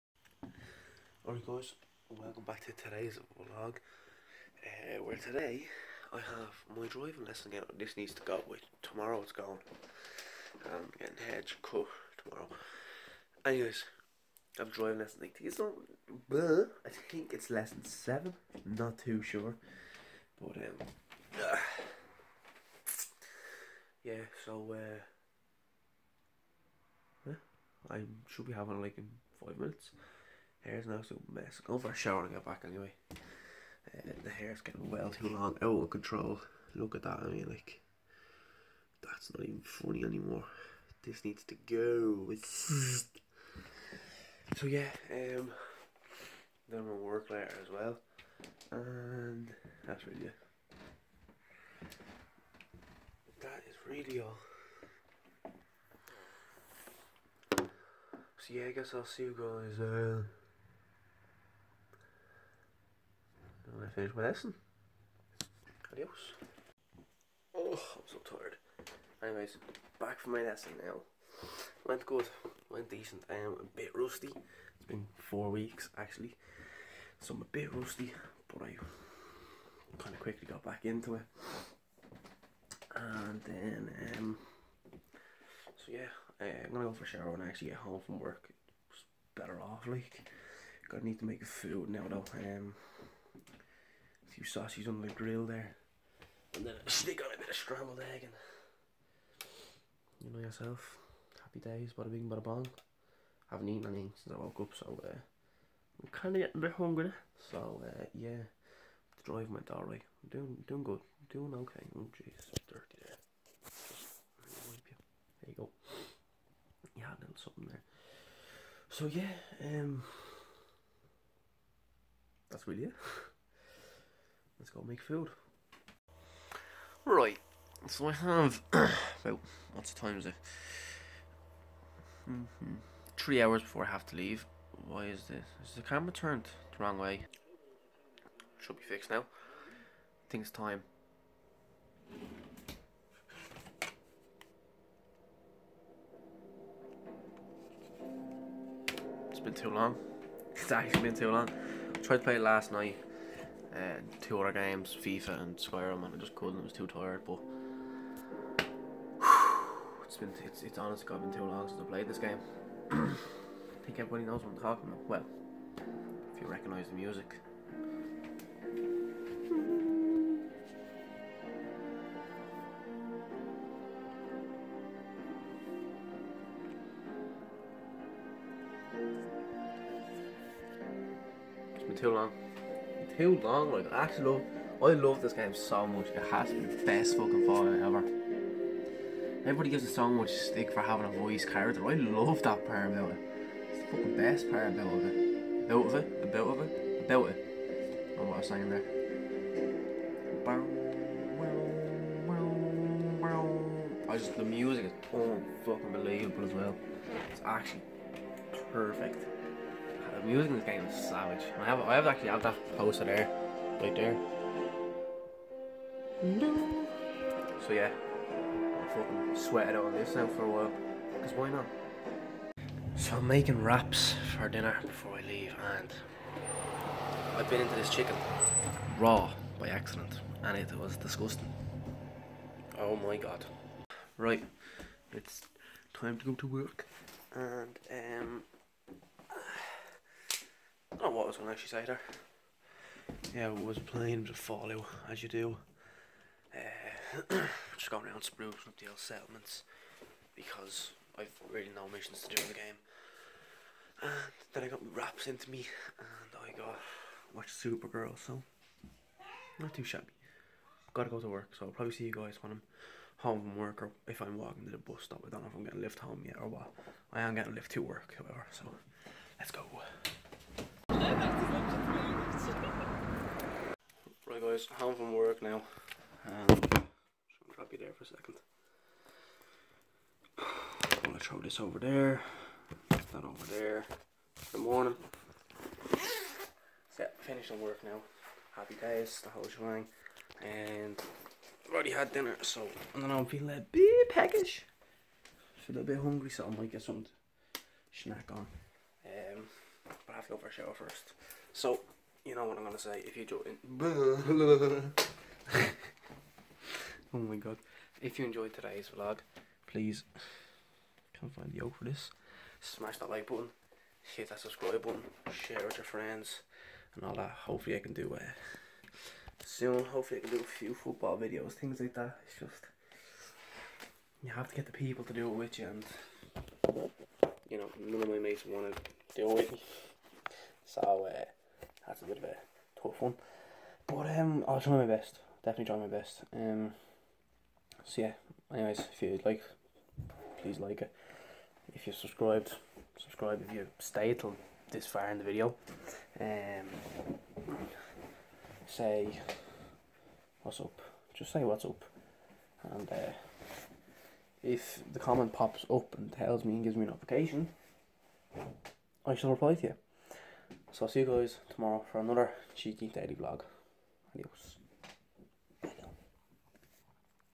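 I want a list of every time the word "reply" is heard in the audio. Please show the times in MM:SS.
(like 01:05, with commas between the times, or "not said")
05:59.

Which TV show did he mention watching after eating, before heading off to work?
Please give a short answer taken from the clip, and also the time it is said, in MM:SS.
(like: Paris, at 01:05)
Supergirl, at 04:17.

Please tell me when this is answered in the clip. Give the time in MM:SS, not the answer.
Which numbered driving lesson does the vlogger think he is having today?
00:17.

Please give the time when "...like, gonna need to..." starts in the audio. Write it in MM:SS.
01:29.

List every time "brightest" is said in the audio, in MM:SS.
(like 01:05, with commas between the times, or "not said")
not said.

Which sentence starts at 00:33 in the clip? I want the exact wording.
Uh, the hair's getting well too long, out of control.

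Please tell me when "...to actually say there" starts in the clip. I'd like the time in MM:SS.
04:01.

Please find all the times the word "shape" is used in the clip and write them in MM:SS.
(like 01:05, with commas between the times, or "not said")
not said.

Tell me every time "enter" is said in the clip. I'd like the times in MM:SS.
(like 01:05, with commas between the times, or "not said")
not said.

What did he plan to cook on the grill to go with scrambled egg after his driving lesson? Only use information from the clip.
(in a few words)
sausages.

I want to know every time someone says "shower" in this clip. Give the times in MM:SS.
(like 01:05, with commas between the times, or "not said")
00:31, 01:27, 05:00.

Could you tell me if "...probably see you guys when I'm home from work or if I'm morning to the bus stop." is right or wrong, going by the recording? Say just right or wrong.
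wrong.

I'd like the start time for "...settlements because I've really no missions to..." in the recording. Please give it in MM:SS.
04:08.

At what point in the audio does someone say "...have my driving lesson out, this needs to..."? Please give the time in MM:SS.
00:06.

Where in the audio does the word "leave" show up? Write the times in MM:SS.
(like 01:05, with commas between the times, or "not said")
02:14, 03:45.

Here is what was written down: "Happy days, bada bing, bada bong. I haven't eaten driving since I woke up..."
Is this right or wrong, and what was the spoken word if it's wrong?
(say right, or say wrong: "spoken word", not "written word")
wrong: "anything", not "driving".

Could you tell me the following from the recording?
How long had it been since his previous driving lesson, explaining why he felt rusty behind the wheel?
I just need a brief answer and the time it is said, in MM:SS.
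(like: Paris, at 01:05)
four weeks, at 01:15.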